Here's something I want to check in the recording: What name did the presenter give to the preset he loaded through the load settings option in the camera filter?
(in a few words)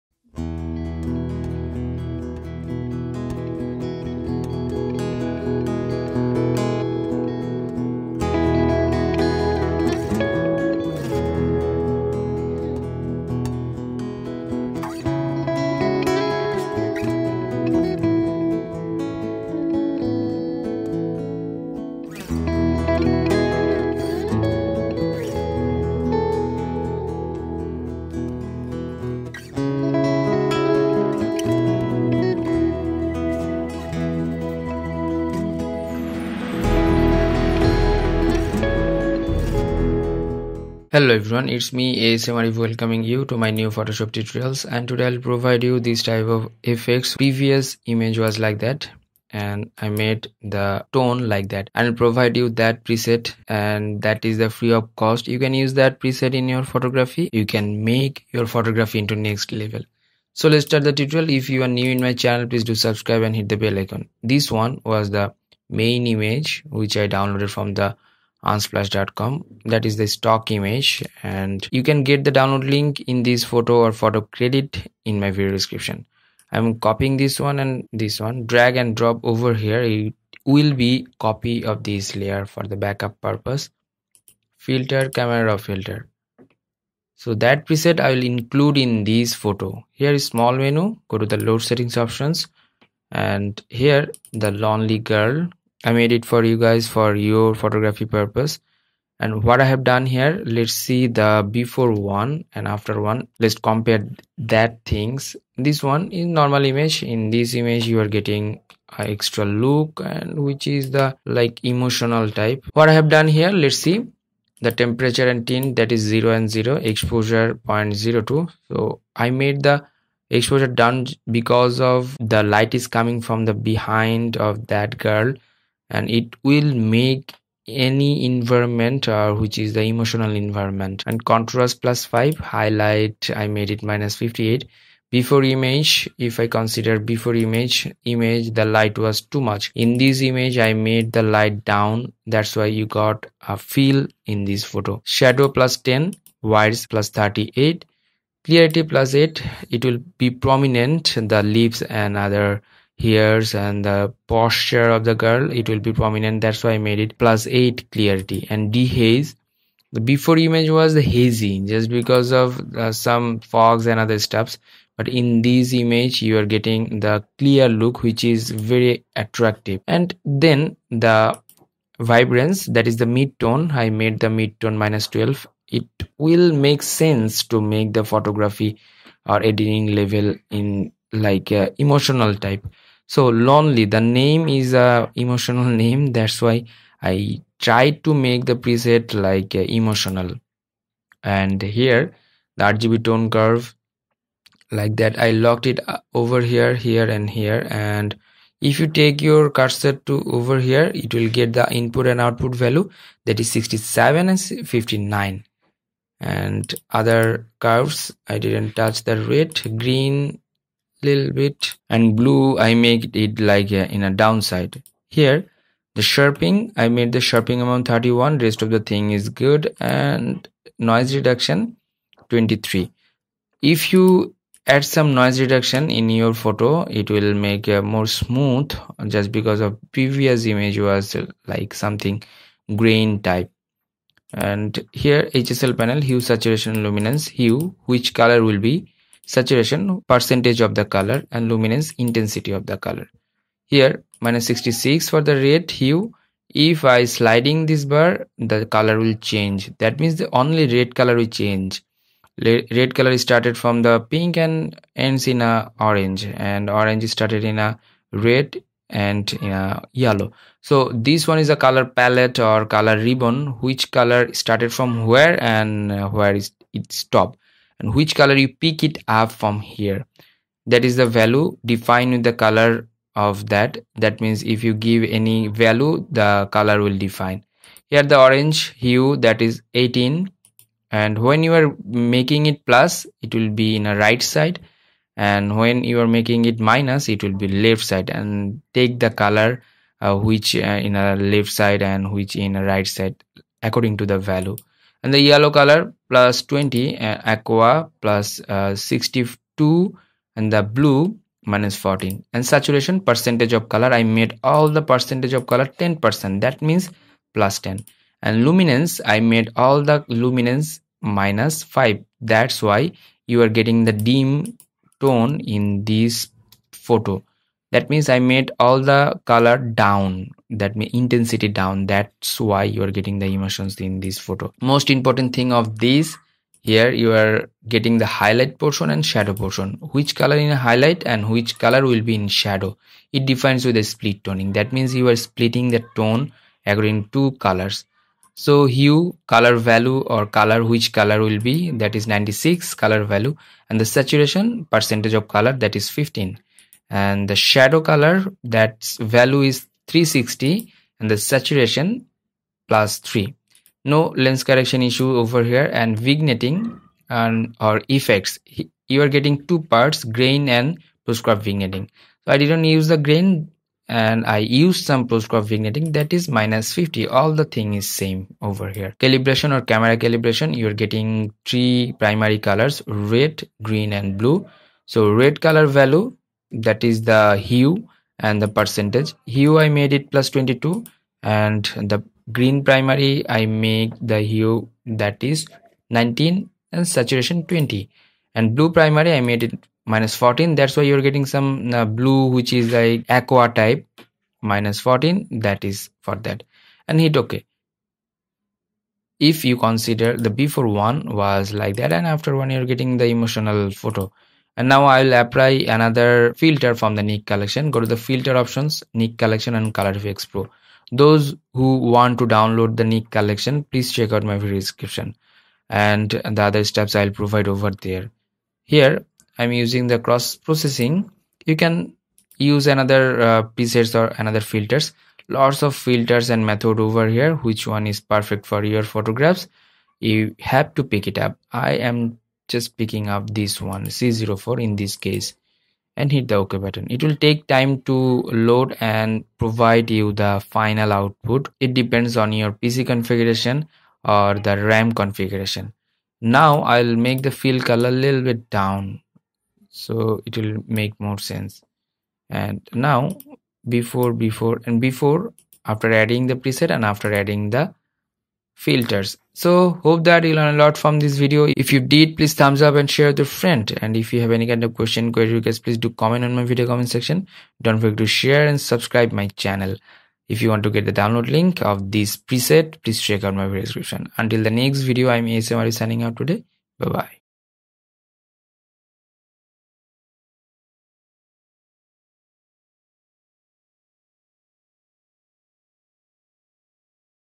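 The Lonely Girl.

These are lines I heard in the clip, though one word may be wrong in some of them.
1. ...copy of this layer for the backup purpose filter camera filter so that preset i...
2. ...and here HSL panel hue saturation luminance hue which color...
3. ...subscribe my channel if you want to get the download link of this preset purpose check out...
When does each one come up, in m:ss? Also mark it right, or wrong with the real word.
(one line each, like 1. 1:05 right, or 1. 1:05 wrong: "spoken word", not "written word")
1. 1:21 right
2. 3:54 right
3. 7:48 wrong: "please", not "purpose".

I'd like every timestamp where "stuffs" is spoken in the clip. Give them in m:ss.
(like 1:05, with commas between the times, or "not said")
2:44.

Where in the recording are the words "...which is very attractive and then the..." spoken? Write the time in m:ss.
2:48.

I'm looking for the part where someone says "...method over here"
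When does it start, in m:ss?
7:06.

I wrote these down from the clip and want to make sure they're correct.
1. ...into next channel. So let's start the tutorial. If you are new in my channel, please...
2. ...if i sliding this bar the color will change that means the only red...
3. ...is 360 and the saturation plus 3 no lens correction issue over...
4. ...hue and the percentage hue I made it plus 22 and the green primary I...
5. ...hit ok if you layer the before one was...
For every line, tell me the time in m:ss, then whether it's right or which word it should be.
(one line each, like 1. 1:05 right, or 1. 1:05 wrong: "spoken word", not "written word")
1. 0:58 wrong: "level", not "channel"
2. 4:06 right
3. 5:49 right
4. 6:17 right
5. 6:36 wrong: "consider", not "layer".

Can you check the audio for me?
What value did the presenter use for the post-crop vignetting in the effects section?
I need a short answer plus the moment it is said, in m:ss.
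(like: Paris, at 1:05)
-50, at 6:06.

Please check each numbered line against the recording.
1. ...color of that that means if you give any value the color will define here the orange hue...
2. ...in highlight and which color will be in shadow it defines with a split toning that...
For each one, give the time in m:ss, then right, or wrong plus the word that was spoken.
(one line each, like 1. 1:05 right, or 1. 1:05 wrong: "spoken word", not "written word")
1. 4:32 right
2. 5:30 right.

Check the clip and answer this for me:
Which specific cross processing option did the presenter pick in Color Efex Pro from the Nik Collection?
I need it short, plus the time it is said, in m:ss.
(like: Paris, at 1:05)
C04, at 7:13.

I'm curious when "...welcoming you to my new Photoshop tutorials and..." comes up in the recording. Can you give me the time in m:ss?
0:42.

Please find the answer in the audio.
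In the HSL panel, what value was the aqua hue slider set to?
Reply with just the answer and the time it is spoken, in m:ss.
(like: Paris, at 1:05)
+62, at 4:58.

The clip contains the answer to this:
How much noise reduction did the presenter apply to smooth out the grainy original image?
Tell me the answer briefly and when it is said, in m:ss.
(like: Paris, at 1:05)
23, at 3:42.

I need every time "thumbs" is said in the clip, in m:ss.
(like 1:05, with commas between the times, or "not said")
7:42.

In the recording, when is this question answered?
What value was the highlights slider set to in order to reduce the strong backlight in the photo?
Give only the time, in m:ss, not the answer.
2:13.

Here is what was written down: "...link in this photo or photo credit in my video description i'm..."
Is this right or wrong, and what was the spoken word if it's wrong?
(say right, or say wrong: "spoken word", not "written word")
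right.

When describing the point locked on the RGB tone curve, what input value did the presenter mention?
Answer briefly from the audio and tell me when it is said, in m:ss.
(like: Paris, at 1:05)
67, at 3:23.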